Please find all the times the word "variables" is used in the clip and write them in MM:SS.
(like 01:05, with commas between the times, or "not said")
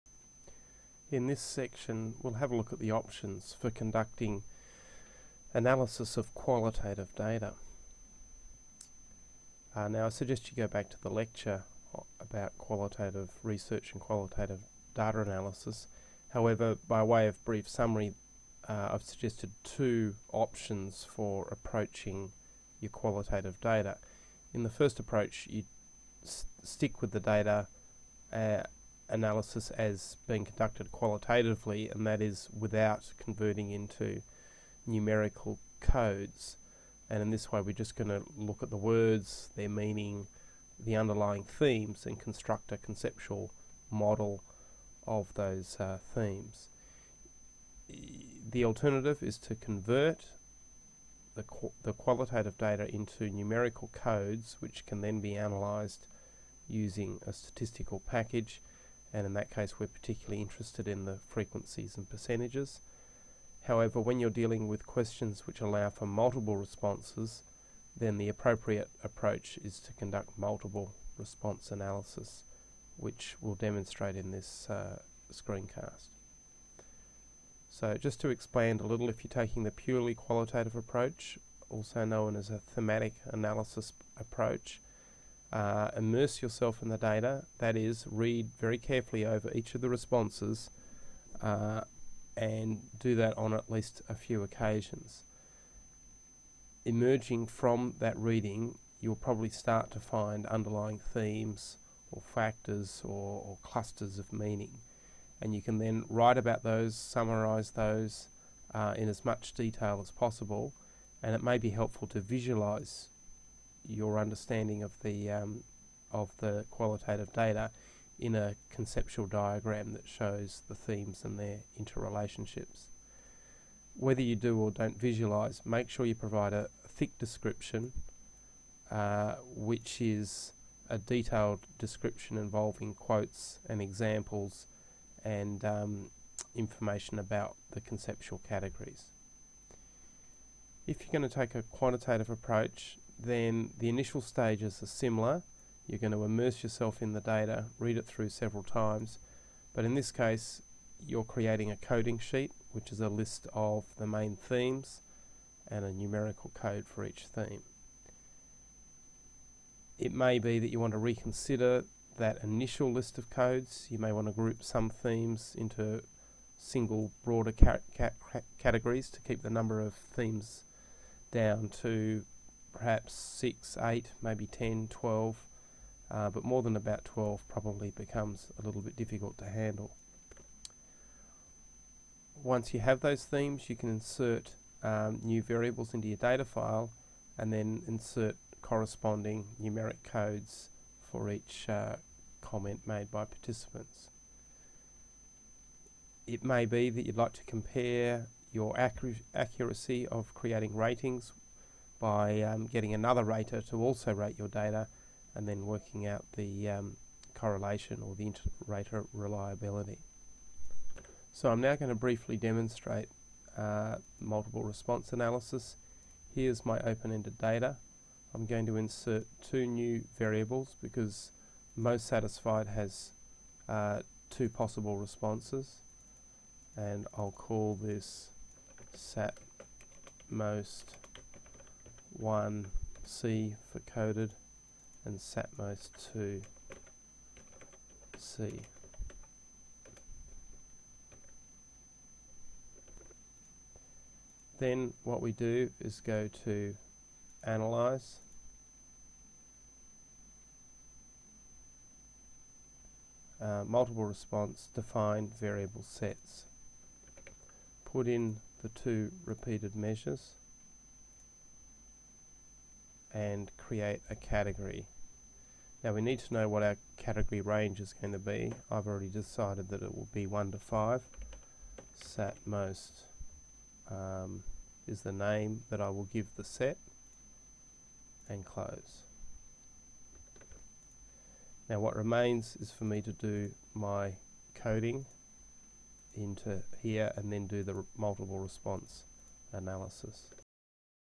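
03:05, 03:40, 04:15.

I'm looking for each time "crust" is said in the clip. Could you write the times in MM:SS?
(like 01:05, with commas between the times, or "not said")
not said.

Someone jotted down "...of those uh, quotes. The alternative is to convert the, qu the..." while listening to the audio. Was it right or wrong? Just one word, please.
wrong.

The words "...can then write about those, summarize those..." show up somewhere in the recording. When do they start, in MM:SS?
01:45.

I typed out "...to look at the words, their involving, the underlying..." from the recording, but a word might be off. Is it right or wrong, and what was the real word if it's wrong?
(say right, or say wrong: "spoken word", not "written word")
wrong: "meaning", not "involving".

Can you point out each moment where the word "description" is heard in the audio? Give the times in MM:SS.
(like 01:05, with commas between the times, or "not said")
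02:07, 02:11.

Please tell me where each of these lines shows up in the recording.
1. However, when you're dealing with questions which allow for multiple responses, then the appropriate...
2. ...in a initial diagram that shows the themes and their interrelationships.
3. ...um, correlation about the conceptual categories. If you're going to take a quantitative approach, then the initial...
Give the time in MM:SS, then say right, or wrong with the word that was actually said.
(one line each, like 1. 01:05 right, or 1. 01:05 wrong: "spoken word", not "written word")
1. 01:03 right
2. 01:58 wrong: "conceptual", not "initial"
3. 02:15 wrong: "information", not "correlation".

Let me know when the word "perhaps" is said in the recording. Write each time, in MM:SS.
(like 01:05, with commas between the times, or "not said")
02:52.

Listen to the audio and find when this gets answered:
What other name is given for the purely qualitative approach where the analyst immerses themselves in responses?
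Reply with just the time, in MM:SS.
01:22.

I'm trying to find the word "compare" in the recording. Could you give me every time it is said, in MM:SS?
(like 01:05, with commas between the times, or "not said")
03:17.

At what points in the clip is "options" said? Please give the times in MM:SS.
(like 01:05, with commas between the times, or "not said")
00:02, 00:20.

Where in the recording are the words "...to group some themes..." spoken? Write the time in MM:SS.
02:44.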